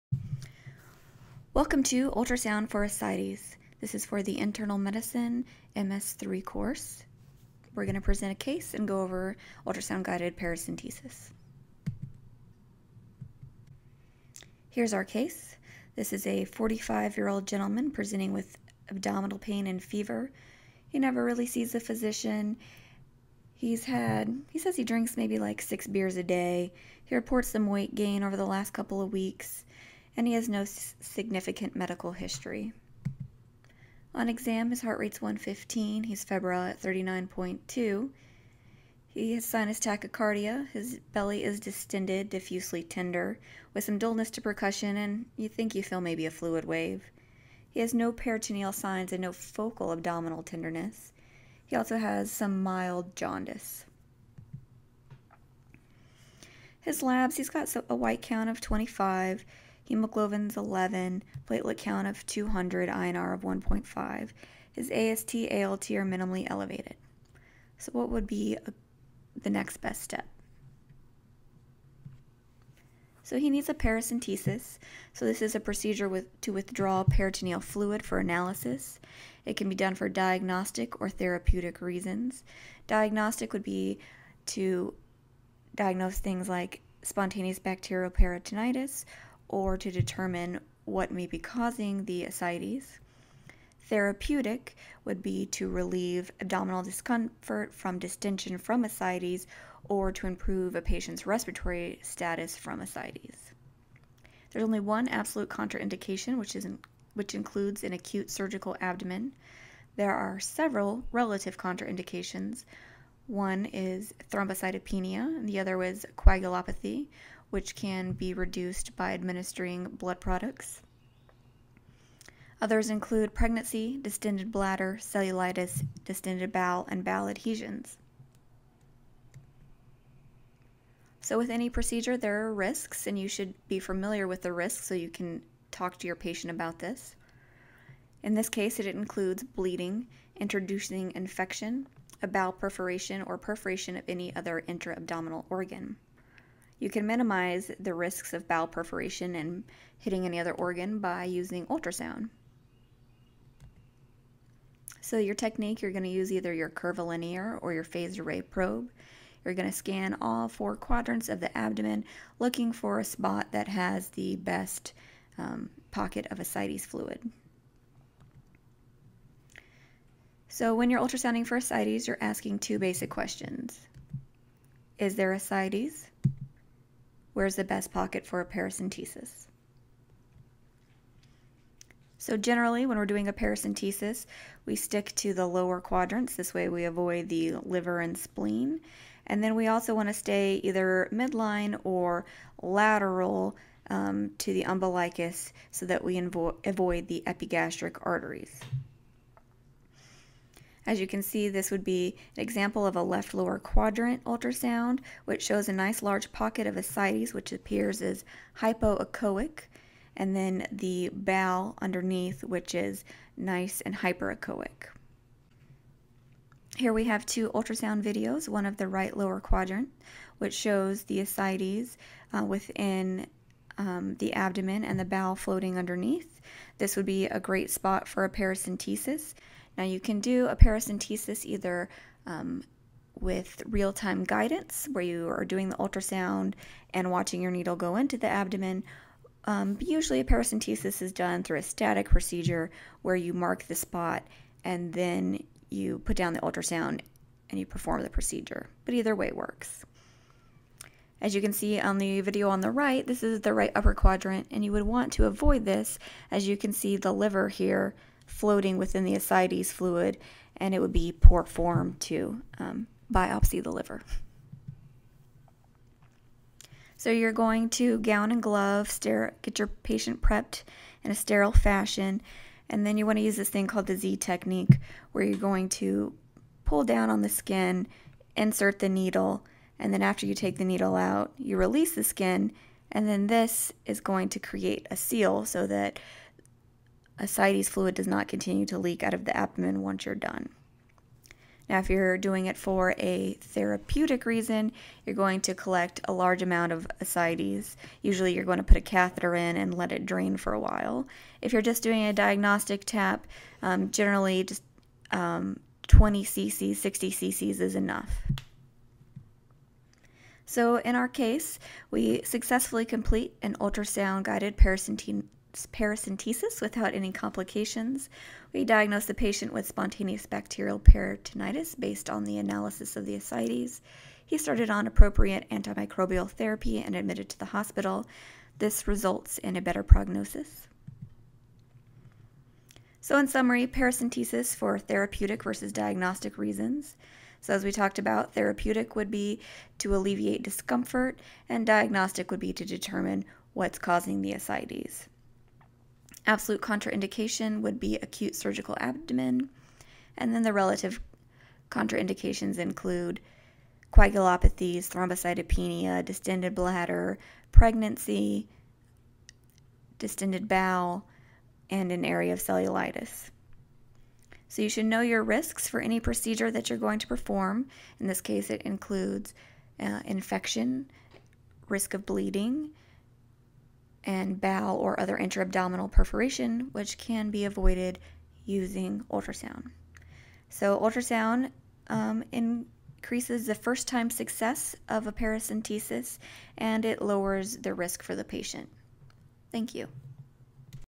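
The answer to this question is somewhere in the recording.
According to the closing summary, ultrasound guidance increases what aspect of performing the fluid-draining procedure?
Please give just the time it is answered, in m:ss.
6:23.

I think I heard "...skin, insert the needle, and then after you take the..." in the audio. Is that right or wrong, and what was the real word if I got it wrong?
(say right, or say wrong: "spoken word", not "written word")
right.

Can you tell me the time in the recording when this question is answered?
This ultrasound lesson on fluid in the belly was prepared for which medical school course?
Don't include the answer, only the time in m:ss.
0:04.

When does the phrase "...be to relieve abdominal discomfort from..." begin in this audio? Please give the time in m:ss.
1:35.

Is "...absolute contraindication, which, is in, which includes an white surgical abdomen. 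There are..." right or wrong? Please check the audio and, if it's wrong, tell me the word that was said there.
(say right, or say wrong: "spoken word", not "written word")
wrong: "acute", not "white".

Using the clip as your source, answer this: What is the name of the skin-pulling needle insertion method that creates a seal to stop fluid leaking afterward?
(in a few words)
Z technique.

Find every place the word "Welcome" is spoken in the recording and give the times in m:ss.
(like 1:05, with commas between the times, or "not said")
0:01.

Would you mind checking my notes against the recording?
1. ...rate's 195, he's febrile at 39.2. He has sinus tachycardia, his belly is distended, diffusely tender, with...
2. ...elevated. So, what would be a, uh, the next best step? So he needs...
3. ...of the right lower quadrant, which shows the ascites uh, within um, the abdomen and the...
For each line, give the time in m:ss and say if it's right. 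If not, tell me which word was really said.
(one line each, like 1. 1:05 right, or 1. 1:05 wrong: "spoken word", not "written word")
1. 0:34 wrong: "115", not "195"
2. 1:06 right
3. 3:38 right.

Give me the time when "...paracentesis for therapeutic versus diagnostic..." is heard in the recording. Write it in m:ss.
5:33.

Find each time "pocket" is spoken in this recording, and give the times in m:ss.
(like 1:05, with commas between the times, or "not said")
2:45, 2:57, 3:26.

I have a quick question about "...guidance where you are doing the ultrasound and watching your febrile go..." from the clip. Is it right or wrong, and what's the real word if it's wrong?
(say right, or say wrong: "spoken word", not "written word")
wrong: "needle", not "febrile".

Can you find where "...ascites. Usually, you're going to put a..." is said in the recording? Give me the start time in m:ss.
4:56.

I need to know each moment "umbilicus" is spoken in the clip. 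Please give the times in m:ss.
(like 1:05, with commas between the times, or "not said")
3:14.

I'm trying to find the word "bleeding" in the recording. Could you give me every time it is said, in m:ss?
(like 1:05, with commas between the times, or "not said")
2:19, 6:12.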